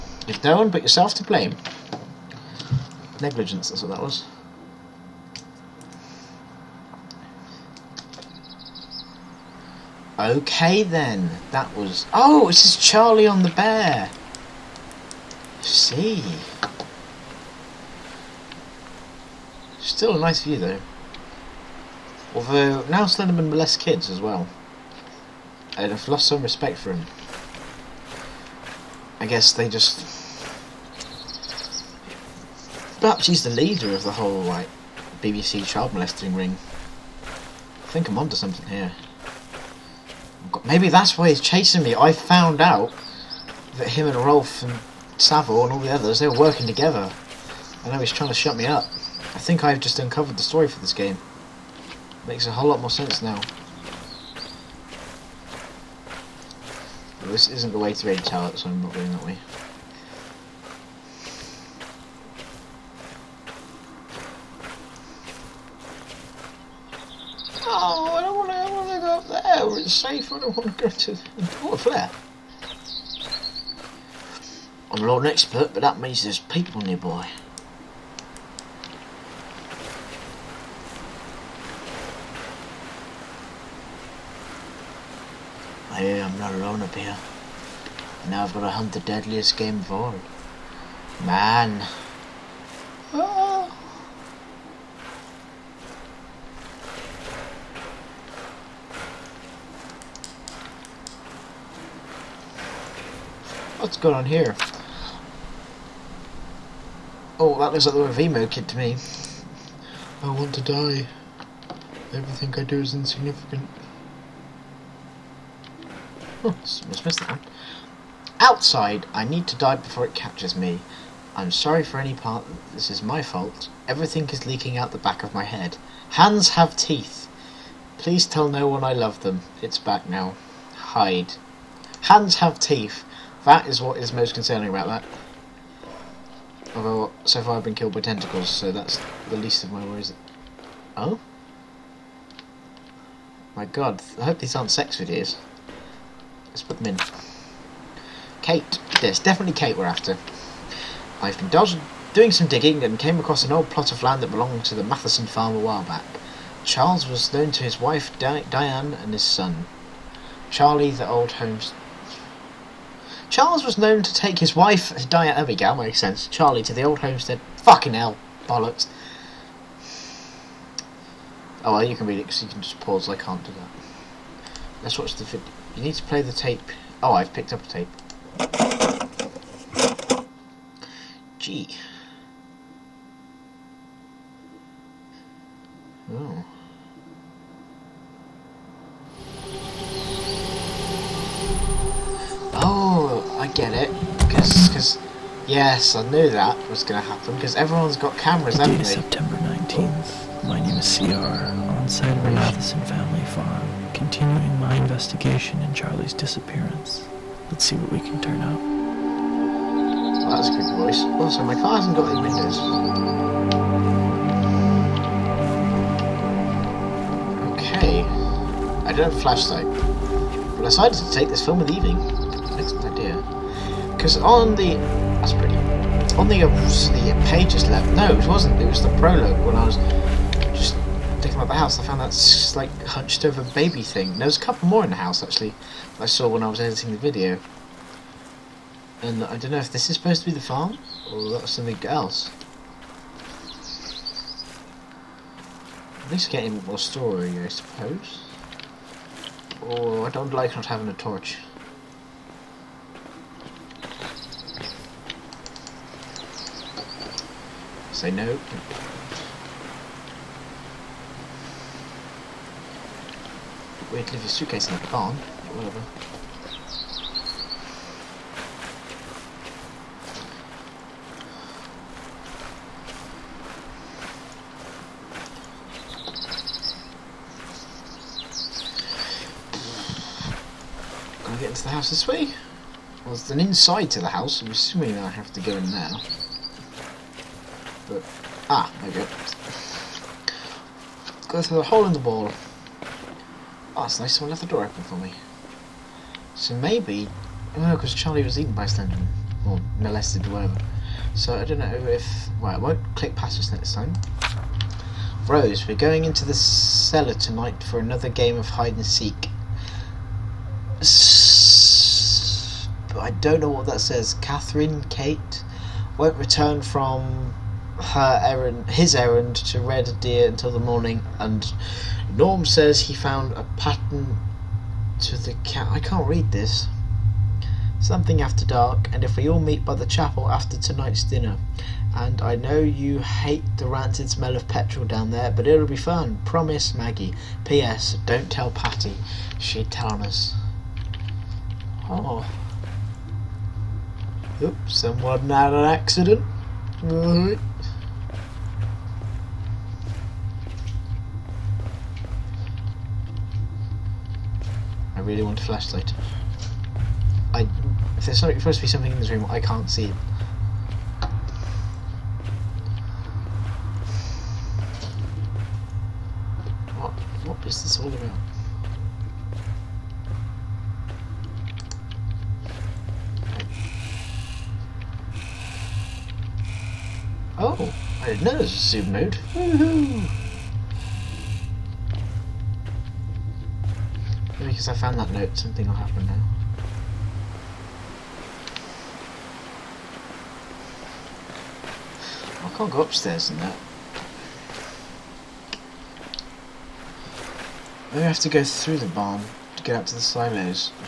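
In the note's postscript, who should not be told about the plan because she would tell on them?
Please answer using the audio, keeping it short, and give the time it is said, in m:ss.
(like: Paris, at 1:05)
Patty, at 5:38.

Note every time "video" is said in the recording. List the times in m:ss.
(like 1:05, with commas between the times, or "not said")
2:24, 2:55, 3:56.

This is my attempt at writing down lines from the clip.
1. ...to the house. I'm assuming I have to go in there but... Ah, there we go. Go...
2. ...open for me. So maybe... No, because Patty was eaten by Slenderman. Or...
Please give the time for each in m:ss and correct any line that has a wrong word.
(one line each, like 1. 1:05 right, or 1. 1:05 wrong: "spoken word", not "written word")
1. 4:43 right
2. 4:54 wrong: "Charlie", not "Patty".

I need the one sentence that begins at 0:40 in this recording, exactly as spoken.
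Maybe that's why he's chasing me.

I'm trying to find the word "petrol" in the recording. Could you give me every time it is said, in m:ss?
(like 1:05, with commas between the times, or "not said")
5:34.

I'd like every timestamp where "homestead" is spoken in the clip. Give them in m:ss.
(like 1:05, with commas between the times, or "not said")
2:41, 2:46.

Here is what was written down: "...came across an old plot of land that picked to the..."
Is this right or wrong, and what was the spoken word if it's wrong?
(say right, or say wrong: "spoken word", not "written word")
wrong: "belonged", not "picked".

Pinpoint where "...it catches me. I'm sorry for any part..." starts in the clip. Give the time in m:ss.
2:00.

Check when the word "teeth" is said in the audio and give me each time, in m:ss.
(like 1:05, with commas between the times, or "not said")
2:06, 2:12.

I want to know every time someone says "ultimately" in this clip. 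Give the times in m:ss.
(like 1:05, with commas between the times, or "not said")
not said.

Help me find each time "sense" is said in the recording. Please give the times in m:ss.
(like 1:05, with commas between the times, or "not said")
0:52, 2:45.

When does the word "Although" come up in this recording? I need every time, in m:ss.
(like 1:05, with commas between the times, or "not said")
0:22, 2:16.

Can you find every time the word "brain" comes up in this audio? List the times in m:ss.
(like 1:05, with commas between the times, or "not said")
not said.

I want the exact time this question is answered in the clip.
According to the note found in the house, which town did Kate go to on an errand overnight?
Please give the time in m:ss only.
5:19.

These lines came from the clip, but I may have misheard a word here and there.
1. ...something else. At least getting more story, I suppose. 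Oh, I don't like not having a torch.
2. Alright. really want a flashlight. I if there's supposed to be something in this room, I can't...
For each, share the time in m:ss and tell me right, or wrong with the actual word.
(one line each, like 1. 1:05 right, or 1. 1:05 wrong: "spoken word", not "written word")
1. 4:01 right
2. 5:46 right.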